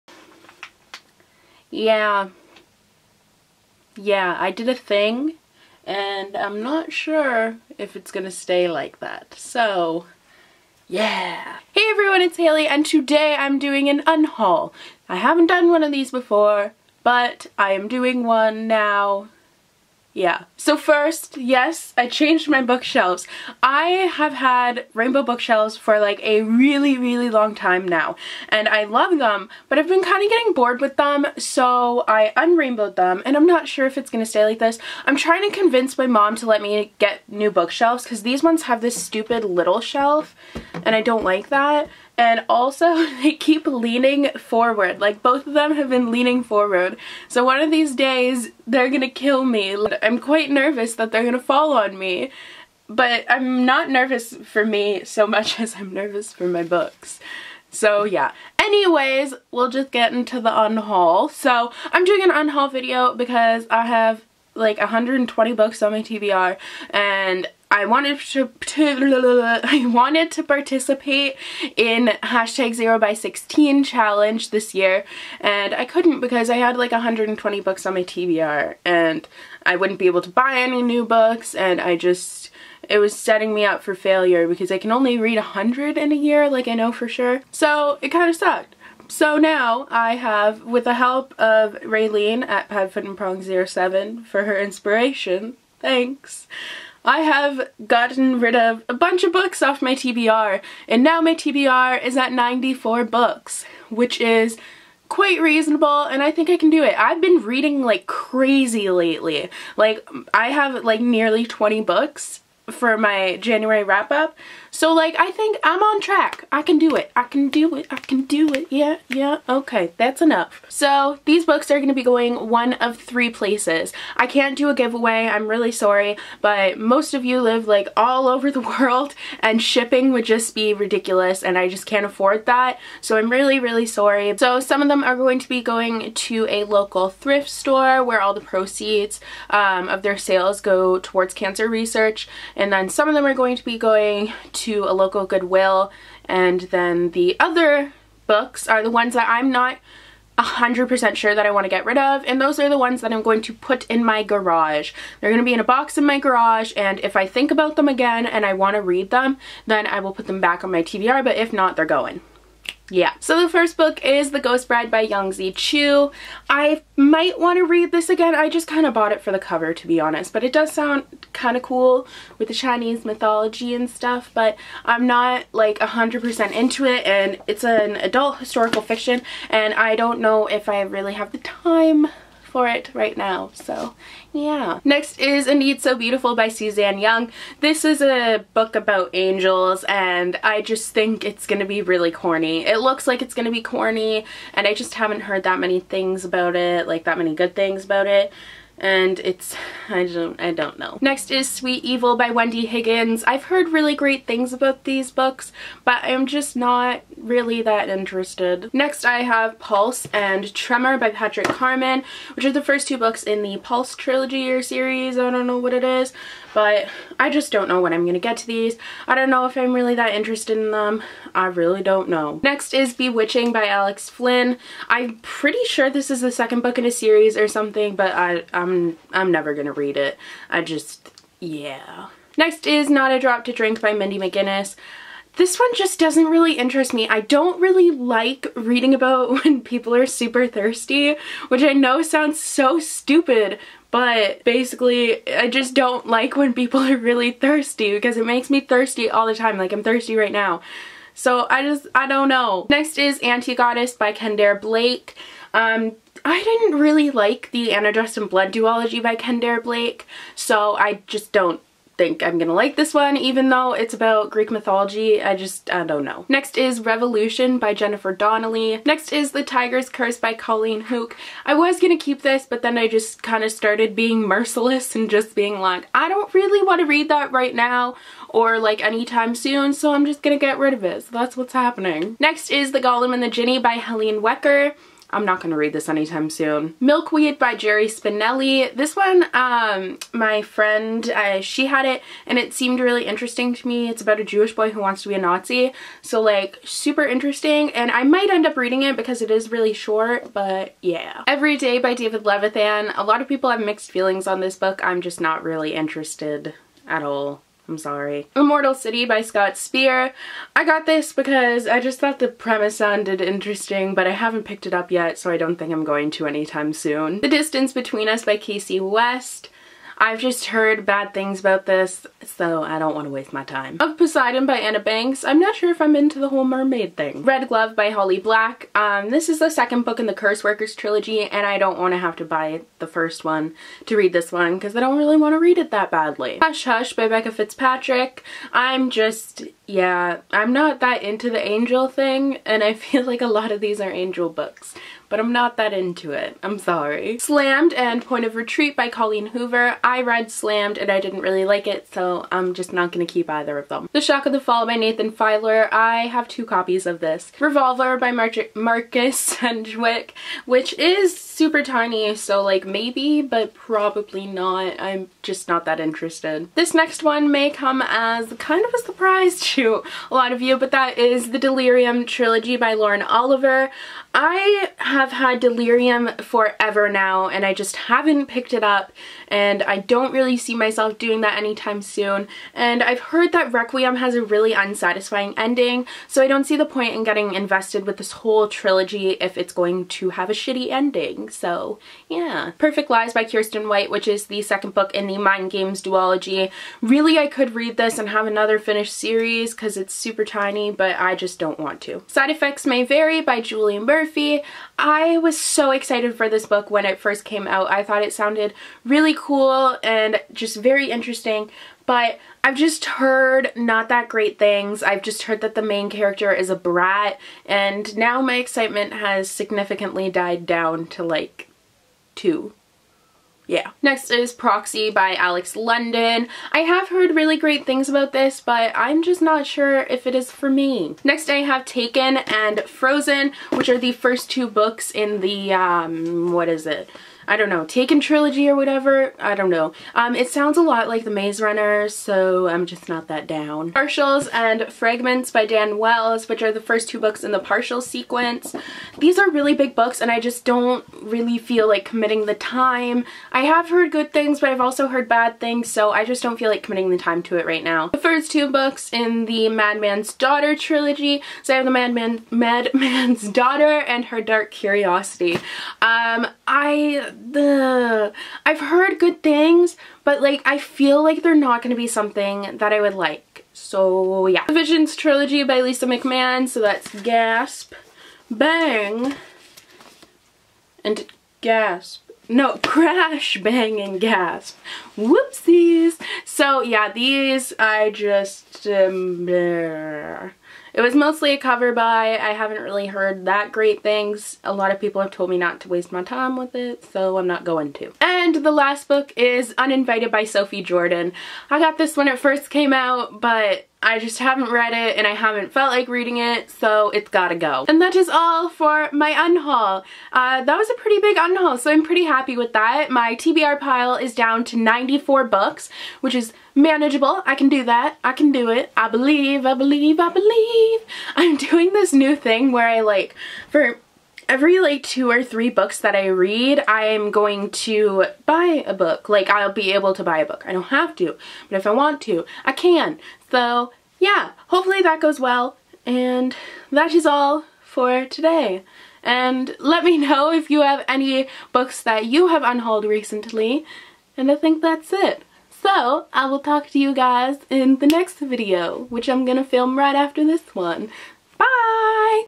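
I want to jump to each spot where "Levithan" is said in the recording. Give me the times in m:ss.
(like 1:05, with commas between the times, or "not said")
5:02.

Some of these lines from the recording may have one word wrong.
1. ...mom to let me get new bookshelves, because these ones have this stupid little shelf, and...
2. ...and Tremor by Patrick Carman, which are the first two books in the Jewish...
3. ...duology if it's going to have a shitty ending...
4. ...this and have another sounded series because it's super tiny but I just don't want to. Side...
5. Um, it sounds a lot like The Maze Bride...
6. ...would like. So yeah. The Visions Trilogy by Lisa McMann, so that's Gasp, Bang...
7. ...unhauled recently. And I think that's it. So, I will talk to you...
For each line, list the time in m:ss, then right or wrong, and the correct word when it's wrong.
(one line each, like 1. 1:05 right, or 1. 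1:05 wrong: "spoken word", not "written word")
1. 0:36 right
2. 3:30 wrong: "Pulse", not "Jewish"
3. 6:28 wrong: "trilogy", not "duology"
4. 6:37 wrong: "finished", not "sounded"
5. 7:19 wrong: "Runner", not "Bride"
6. 7:52 right
7. 9:02 right.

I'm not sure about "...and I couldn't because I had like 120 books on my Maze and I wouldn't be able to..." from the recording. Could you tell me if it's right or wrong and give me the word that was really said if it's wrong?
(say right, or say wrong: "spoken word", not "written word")
wrong: "TBR", not "Maze".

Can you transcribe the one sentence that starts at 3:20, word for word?
Next is Sweet Evil by Wendy Higgins.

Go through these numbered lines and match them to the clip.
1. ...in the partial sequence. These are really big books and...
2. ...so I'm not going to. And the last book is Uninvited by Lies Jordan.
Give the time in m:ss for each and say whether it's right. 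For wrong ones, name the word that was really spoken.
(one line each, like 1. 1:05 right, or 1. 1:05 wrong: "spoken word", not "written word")
1. 7:27 right
2. 8:16 wrong: "Sophie", not "Lies".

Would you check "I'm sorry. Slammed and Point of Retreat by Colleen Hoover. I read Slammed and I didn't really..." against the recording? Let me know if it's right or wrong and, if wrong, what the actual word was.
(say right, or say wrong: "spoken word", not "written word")
right.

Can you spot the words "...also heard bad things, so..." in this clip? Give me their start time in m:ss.
7:34.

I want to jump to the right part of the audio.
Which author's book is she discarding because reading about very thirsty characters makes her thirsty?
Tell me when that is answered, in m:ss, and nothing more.
3:53.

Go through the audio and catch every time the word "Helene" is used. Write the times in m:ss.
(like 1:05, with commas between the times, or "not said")
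4:43.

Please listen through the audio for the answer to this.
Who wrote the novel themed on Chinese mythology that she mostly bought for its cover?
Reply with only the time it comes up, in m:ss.
2:45.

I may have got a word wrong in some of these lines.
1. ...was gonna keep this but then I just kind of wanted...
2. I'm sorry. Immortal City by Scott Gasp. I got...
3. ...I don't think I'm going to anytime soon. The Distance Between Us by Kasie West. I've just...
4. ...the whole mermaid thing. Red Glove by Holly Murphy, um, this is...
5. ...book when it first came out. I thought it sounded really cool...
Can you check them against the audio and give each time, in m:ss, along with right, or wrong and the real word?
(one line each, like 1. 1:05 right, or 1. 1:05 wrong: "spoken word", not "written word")
1. 4:31 wrong: "started", not "wanted"
2. 5:07 wrong: "Speer", not "Gasp"
3. 5:15 right
4. 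5:26 wrong: "Black", not "Murphy"
5. 6:46 right.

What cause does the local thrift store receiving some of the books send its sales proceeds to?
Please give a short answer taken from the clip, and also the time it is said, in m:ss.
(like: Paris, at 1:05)
Cancer research, at 2:21.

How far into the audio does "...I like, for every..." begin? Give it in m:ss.
8:42.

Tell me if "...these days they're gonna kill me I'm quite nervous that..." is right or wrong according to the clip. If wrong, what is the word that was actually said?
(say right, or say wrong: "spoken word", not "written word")
right.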